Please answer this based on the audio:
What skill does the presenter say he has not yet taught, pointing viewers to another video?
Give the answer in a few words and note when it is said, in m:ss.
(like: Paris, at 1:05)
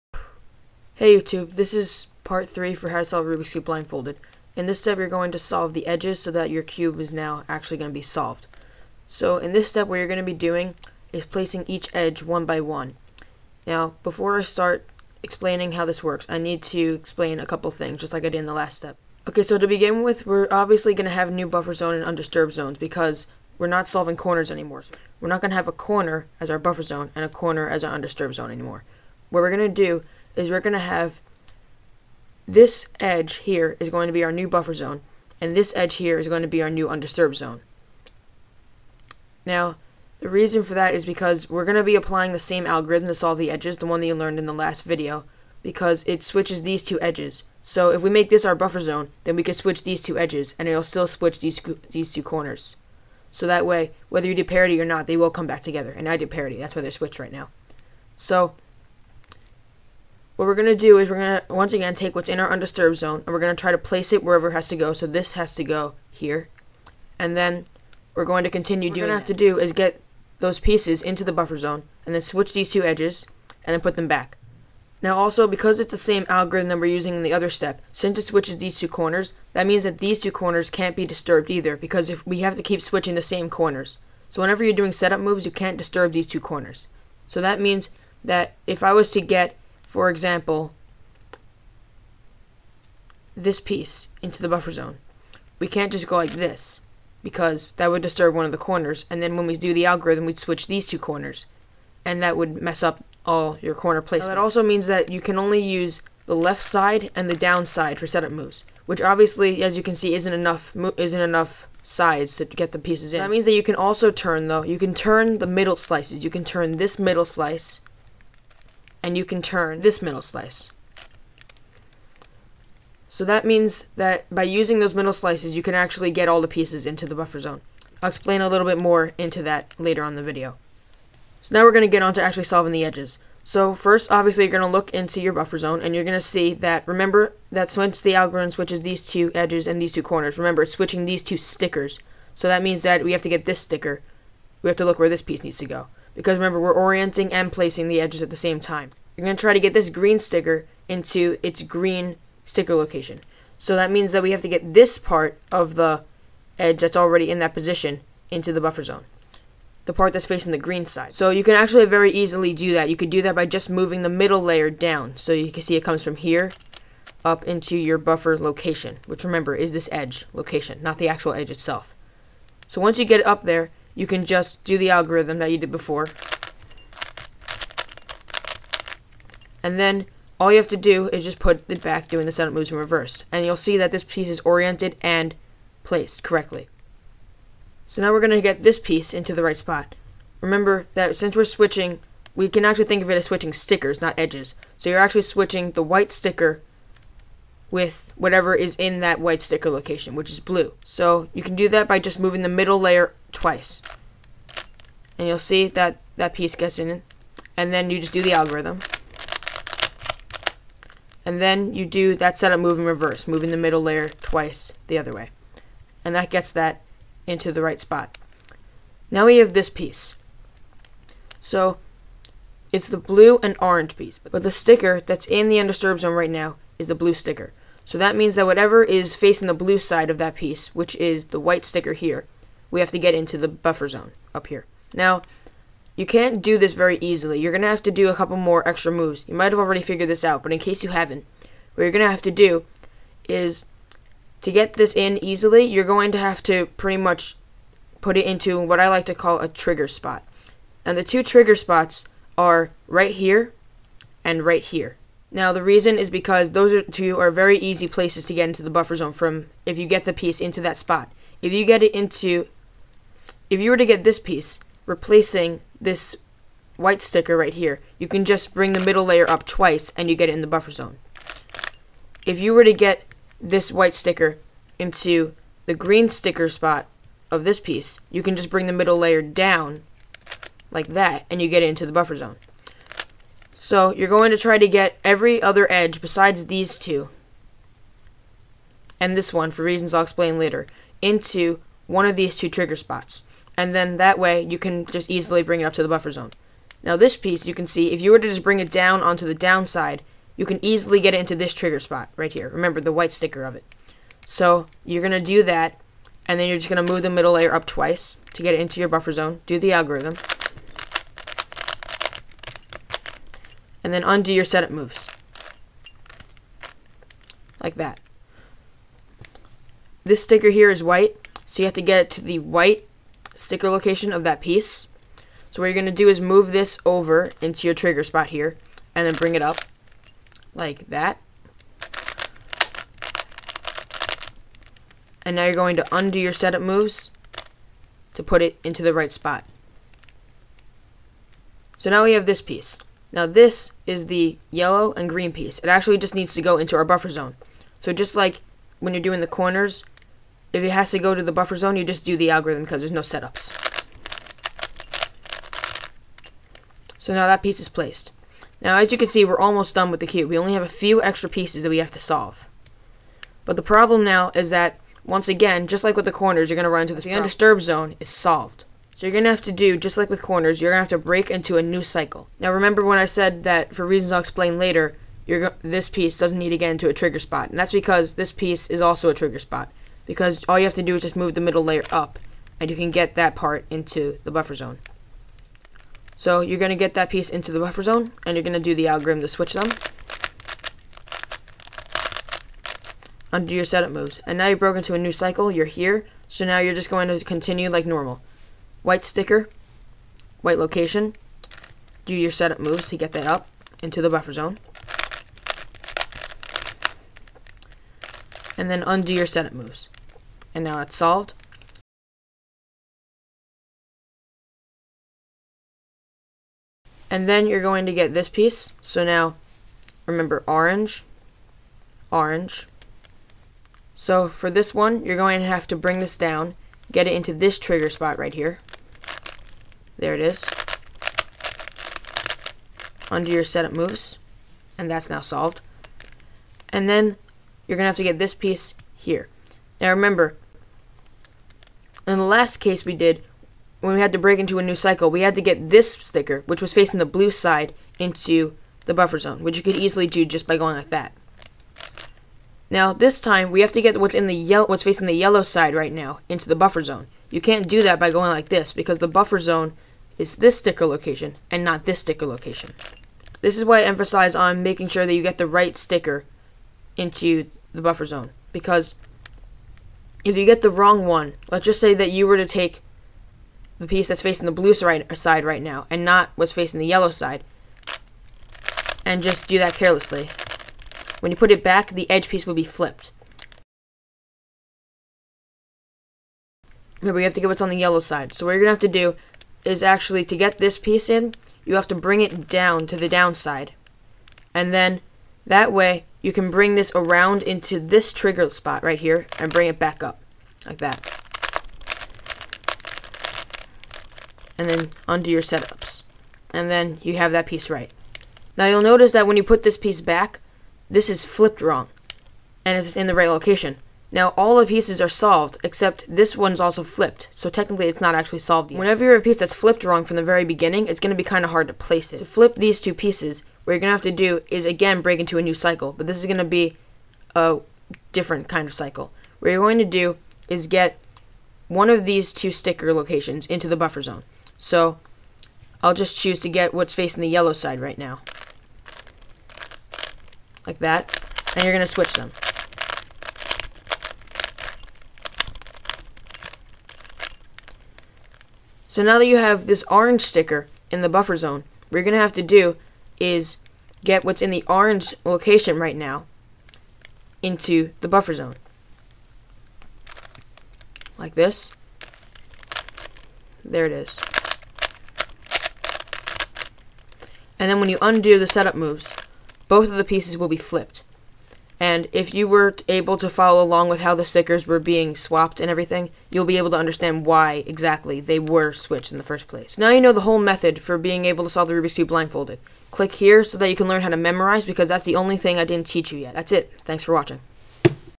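how to memorize, at 9:44.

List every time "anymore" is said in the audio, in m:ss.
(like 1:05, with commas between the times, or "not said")
0:24, 0:28.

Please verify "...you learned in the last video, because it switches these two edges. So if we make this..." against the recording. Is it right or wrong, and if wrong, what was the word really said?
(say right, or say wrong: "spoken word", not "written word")
right.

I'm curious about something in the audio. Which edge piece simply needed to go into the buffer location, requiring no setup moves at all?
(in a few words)
yellow and green.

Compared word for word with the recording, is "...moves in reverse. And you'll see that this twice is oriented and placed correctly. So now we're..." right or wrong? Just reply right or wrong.
wrong.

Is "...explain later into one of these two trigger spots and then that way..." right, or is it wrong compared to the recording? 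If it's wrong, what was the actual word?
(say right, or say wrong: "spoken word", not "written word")
right.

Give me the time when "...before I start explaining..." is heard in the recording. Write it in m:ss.
0:14.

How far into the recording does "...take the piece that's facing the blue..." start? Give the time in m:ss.
7:52.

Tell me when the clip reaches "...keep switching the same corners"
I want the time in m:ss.
1:22.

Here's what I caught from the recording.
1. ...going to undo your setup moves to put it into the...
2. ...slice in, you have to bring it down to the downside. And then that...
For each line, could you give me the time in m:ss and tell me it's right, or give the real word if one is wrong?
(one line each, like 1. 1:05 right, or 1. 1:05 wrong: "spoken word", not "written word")
1. 5:35 right
2. 8:10 wrong: "piece", not "slice".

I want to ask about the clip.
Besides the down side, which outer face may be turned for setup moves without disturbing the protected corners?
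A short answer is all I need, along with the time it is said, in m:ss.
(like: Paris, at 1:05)
left side, at 1:46.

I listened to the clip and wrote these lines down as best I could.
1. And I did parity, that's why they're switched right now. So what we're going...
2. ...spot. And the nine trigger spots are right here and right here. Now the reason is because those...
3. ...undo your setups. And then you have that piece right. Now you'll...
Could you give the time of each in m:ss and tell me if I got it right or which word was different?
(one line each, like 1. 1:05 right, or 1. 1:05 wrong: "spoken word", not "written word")
1. 0:55 right
2. 4:09 wrong: "two", not "nine"
3. 8:25 right.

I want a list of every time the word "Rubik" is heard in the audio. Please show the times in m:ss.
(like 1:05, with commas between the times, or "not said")
0:03, 9:41.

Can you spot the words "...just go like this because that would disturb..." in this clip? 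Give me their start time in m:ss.
1:35.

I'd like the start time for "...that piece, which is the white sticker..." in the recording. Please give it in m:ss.
3:50.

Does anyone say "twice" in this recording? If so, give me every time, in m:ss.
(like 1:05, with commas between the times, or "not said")
3:23, 3:34, 4:29, 5:07.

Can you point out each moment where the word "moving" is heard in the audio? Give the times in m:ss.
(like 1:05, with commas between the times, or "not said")
2:43, 3:22, 3:33.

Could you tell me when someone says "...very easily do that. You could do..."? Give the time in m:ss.
2:41.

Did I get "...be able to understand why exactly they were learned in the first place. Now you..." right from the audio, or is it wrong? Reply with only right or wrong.
wrong.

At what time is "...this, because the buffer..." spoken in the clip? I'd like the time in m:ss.
7:38.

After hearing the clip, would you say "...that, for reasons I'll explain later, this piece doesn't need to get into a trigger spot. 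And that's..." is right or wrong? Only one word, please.
right.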